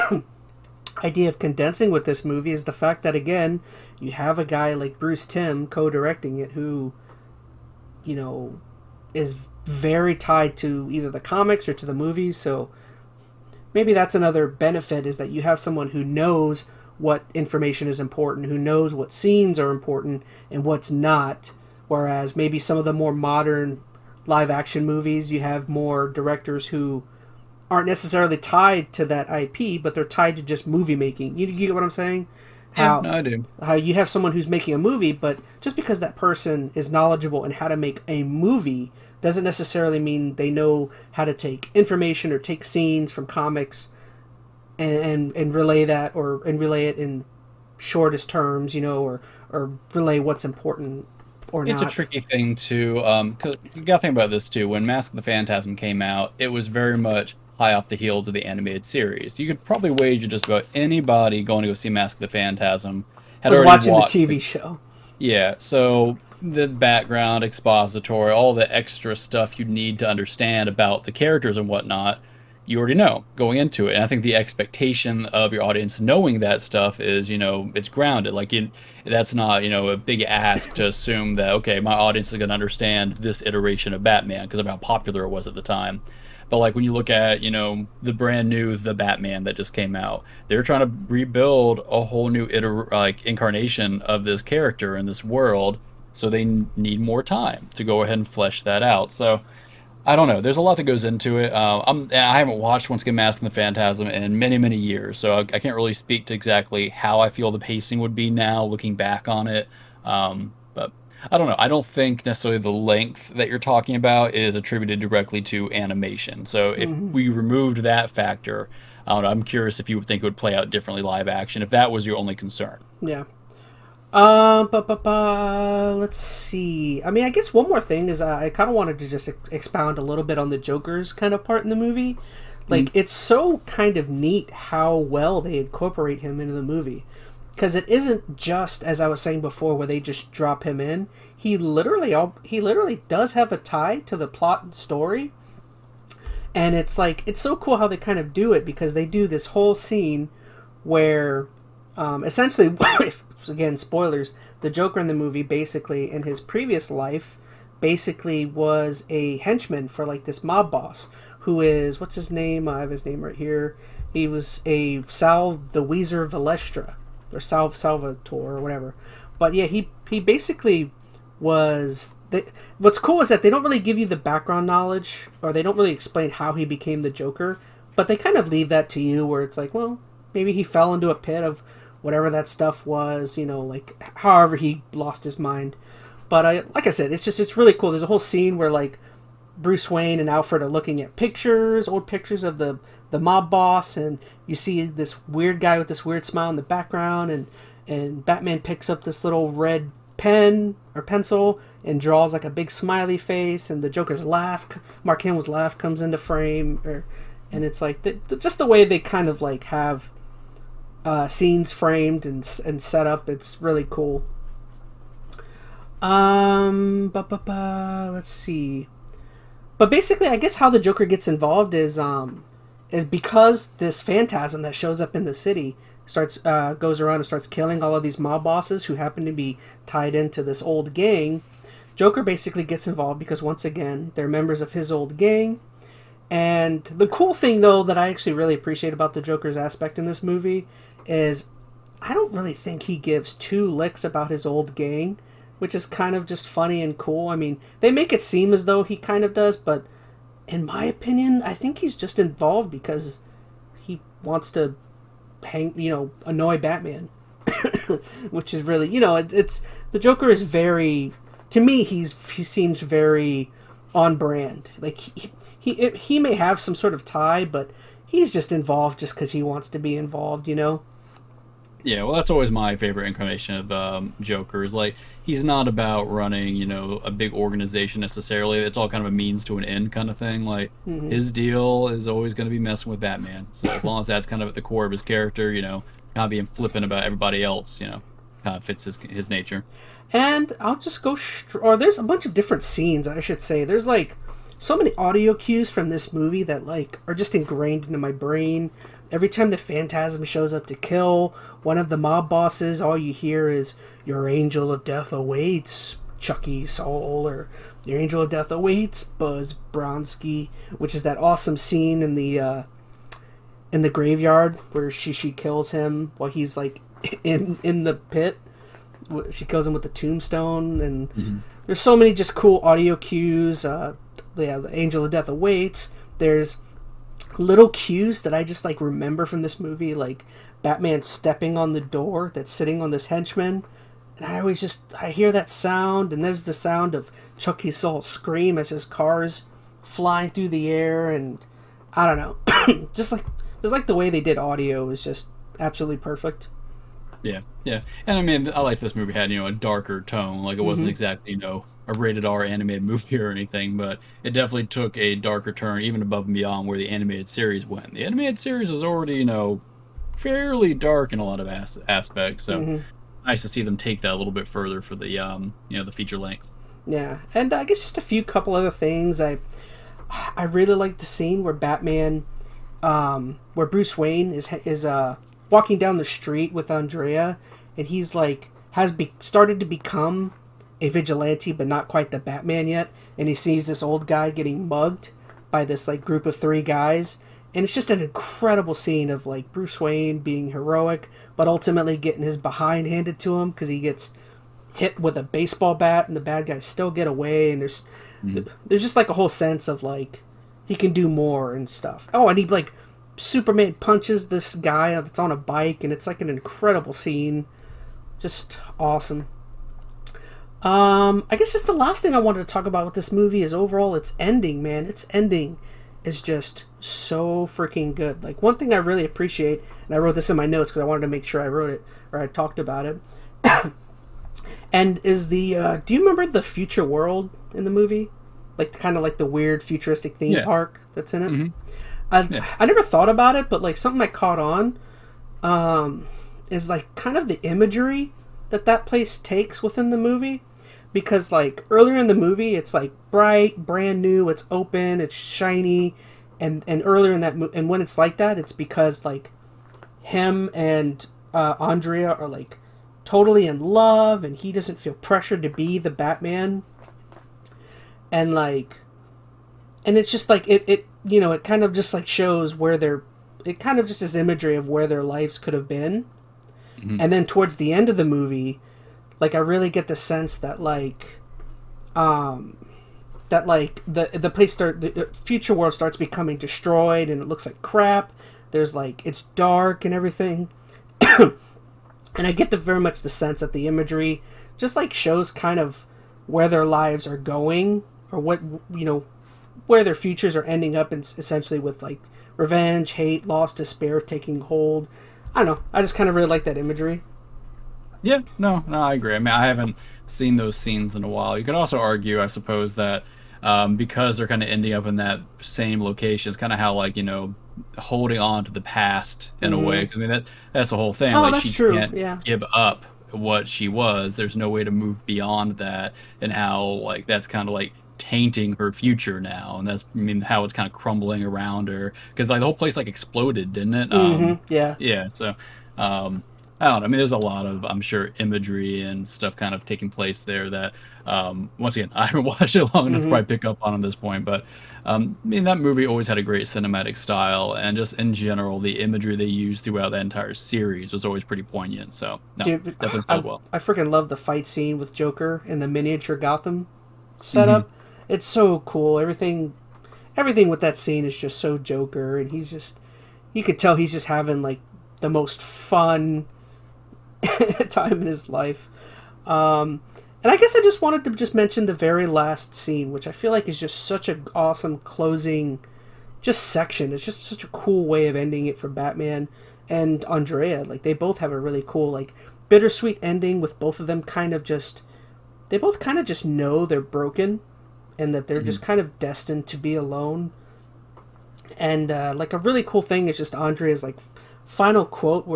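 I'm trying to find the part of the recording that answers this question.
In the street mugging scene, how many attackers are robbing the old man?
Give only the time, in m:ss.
6:26.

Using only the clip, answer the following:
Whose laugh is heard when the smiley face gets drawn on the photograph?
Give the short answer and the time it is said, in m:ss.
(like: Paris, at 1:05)
Mark Hamill, at 3:25.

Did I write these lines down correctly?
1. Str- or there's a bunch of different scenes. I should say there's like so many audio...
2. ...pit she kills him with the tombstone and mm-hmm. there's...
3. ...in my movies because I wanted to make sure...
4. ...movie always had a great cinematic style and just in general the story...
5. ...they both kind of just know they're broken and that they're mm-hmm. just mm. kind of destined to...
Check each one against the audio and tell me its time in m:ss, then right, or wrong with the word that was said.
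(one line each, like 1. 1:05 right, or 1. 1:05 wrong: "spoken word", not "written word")
1. 4:51 right
2. 5:17 right
3. 7:00 wrong: "notes", not "movies"
4. 8:55 wrong: "imagery", not "story"
5. 9:35 right.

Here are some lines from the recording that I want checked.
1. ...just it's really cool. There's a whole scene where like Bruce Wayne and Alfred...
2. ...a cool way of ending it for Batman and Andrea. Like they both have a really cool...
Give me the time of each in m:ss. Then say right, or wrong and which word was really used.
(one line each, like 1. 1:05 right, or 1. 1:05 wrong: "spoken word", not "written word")
1. 3:07 right
2. 9:27 right.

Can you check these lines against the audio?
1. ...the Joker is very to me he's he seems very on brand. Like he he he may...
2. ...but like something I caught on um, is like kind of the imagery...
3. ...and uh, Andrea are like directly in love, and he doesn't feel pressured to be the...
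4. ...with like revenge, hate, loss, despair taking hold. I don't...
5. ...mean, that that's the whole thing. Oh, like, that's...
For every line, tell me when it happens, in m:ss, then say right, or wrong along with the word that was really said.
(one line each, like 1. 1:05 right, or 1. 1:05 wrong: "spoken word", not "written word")
1. 4:19 right
2. 7:13 right
3. 7:30 wrong: "totally", not "directly"
4. 8:11 right
5. 8:30 right.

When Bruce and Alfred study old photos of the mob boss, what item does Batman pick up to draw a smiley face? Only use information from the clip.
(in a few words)
red pen.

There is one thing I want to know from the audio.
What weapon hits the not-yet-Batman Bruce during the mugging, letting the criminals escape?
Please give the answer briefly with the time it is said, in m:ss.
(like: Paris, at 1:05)
baseball bat, at 6:35.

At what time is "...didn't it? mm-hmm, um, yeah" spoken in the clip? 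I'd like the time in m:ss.
8:43.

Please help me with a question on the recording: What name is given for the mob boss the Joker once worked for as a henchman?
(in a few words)
Sal the Wheezer Valestra.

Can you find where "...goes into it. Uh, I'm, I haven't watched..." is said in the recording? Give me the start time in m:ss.
1:40.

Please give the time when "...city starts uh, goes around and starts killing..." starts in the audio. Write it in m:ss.
3:45.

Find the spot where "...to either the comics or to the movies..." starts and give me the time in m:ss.
0:10.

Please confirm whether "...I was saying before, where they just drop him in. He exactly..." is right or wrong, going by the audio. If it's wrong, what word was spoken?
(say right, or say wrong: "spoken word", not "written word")
wrong: "literally", not "exactly".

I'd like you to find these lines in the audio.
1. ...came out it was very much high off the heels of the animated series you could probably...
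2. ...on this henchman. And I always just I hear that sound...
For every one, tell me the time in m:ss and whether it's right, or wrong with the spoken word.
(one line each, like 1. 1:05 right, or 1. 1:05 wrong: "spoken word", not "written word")
1. 0:55 right
2. 5:32 right.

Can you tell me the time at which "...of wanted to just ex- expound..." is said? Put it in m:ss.
2:08.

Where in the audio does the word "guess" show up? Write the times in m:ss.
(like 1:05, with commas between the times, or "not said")
2:07, 3:40, 6:07, 6:51, 9:20.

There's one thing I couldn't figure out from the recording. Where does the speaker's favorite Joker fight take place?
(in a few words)
miniature Gotham.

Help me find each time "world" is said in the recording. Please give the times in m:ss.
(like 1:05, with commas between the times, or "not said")
1:35, 7:06, 7:55.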